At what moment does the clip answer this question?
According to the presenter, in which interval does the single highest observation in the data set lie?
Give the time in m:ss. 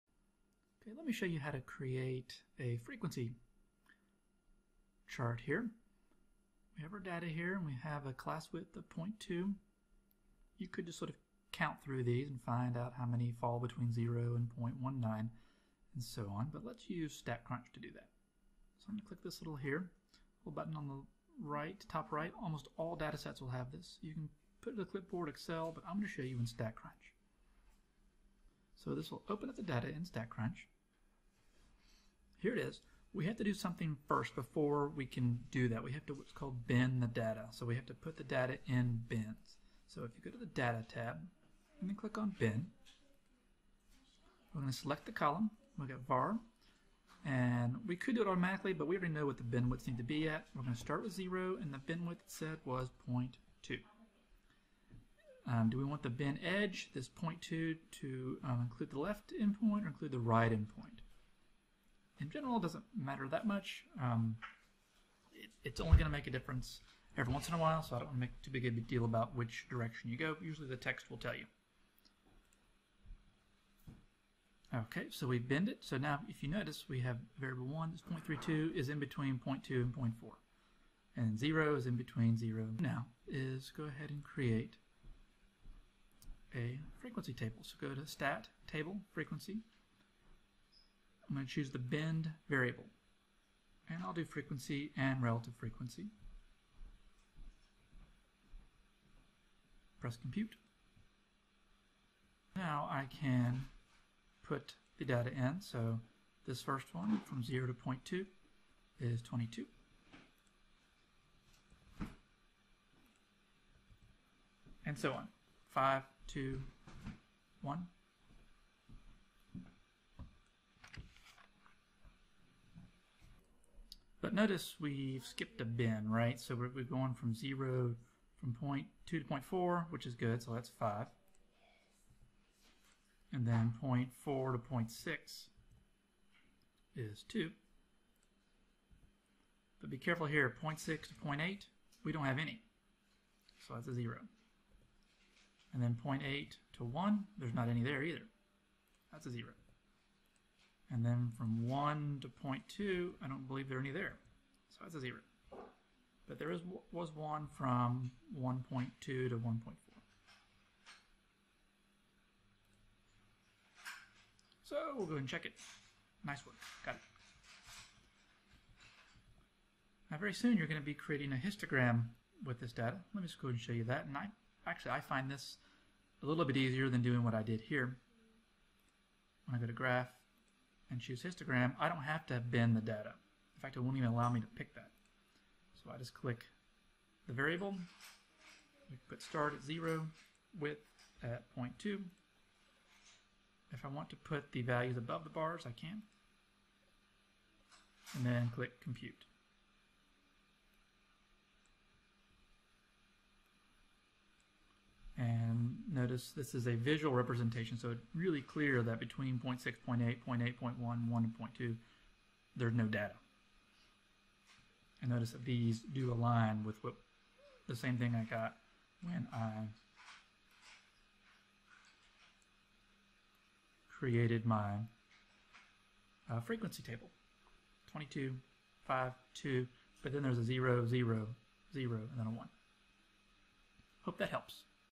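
2:38.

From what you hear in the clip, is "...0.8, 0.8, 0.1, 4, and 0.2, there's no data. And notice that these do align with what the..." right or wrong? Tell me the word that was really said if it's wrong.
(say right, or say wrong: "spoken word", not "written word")
wrong: "1", not "4".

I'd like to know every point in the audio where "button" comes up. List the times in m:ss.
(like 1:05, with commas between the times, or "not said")
0:20.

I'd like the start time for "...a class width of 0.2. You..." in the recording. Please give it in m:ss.
0:08.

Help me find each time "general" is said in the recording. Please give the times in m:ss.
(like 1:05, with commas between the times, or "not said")
1:02.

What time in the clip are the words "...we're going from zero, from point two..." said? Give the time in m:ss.
2:06.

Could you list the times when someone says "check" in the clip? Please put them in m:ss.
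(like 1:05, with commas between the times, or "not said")
2:45.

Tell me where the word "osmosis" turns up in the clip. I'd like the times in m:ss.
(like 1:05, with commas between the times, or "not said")
not said.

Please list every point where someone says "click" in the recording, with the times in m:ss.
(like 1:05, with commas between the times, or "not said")
0:19, 0:41, 3:06, 3:18.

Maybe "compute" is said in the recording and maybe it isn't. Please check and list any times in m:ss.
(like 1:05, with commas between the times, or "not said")
1:40, 3:18.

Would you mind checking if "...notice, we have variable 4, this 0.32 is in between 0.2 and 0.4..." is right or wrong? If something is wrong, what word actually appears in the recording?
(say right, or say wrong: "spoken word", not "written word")
wrong: "1", not "4".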